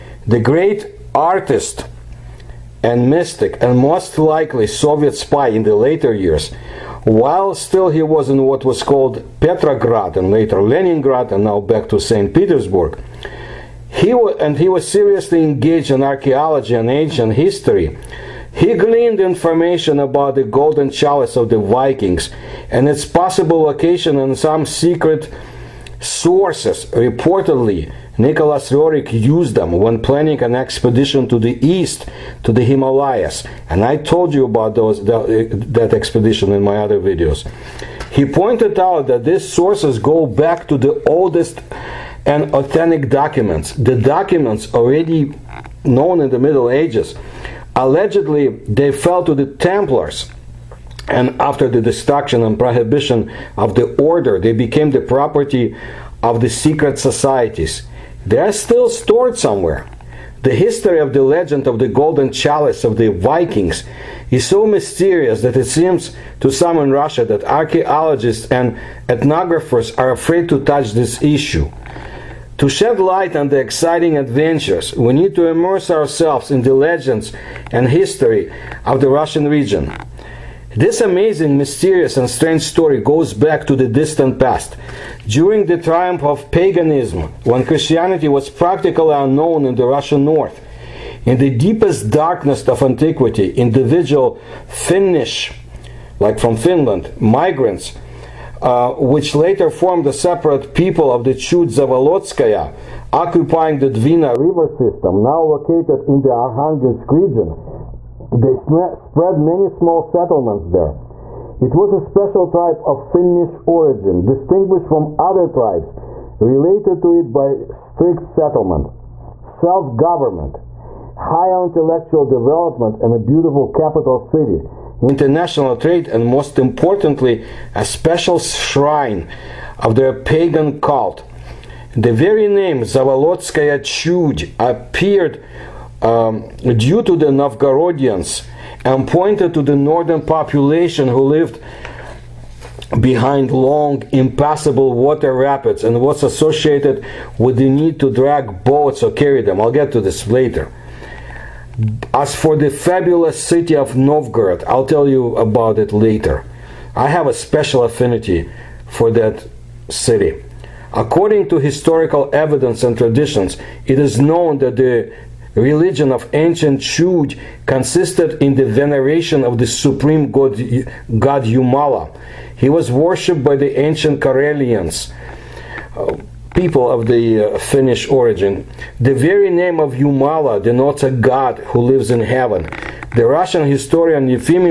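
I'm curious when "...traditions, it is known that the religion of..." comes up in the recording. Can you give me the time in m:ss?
2:42.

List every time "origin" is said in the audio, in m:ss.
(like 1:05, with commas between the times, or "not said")
1:53, 2:58.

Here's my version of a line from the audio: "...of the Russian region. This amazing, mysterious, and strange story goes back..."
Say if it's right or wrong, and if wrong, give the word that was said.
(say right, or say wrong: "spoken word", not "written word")
right.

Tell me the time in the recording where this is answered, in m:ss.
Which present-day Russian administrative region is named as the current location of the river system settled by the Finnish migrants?
1:46.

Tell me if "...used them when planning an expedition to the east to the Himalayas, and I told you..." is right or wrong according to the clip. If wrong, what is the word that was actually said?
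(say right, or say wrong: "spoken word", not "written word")
right.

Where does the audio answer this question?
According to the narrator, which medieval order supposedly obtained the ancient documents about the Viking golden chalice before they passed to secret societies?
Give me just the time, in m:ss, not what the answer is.
0:49.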